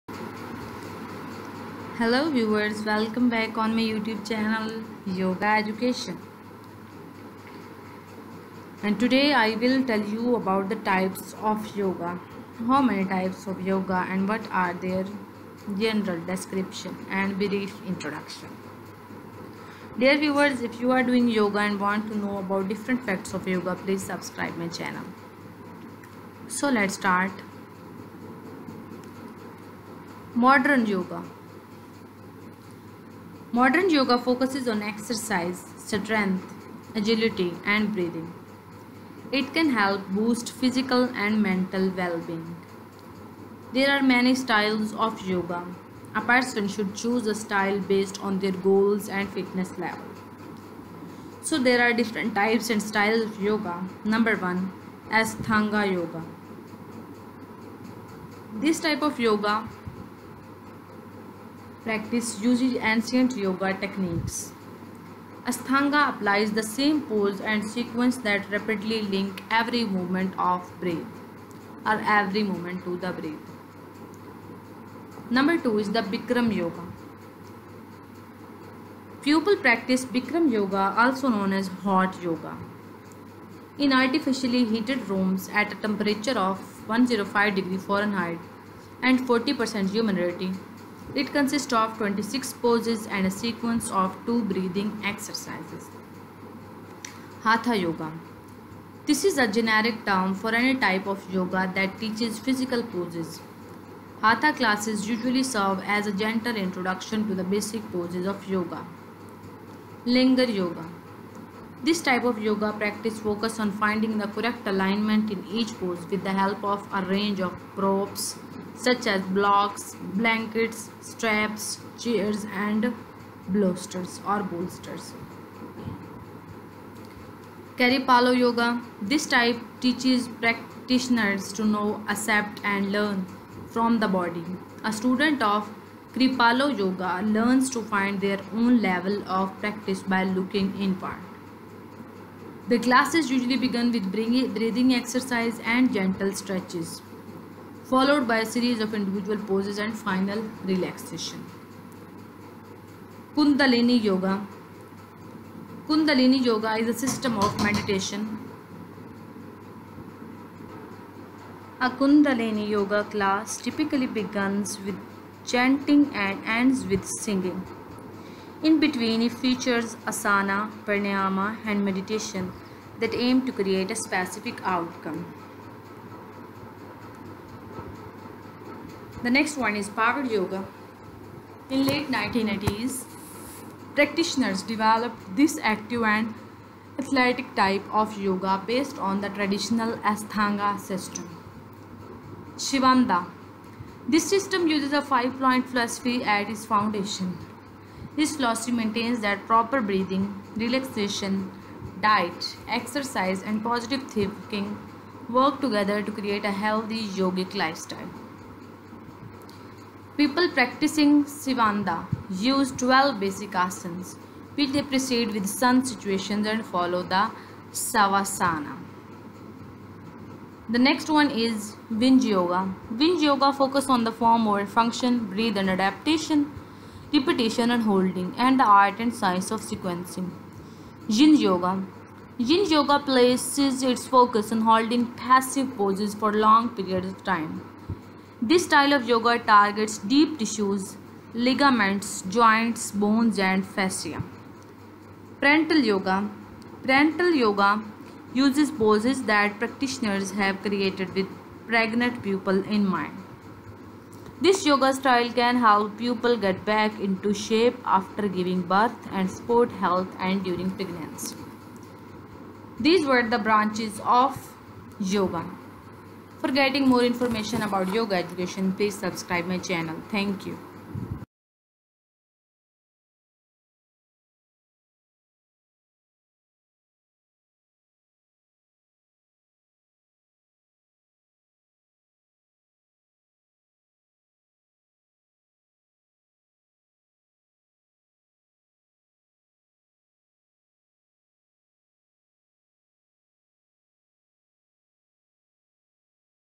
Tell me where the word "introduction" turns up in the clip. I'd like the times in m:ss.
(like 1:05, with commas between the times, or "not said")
0:17, 1:46.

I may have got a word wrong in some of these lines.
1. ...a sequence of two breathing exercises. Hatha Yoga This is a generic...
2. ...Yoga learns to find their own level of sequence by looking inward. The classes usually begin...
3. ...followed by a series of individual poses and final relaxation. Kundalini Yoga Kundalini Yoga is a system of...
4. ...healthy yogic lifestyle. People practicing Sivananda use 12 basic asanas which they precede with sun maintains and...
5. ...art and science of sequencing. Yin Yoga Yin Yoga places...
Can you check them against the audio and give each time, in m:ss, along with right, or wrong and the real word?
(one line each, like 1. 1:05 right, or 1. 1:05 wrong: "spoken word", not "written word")
1. 1:33 right
2. 2:16 wrong: "practice", not "sequence"
3. 2:27 right
4. 3:26 wrong: "salutations", not "maintains"
5. 3:48 right.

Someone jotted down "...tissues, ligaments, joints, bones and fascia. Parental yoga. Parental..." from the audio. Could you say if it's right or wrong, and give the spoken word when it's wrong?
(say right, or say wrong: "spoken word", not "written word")
right.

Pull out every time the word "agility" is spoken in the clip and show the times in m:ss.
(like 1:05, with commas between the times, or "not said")
0:36.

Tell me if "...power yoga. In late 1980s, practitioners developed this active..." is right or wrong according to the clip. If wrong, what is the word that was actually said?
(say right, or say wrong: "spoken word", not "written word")
right.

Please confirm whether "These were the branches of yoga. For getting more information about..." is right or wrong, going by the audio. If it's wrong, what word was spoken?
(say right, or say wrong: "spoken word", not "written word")
right.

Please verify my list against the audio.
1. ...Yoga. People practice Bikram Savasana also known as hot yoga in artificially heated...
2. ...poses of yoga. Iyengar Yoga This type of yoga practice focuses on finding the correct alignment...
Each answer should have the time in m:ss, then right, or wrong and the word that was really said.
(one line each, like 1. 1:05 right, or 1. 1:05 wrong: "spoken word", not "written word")
1. 1:16 wrong: "Yoga", not "Savasana"
2. 1:47 right.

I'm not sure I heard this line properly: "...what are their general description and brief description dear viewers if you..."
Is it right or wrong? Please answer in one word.
wrong.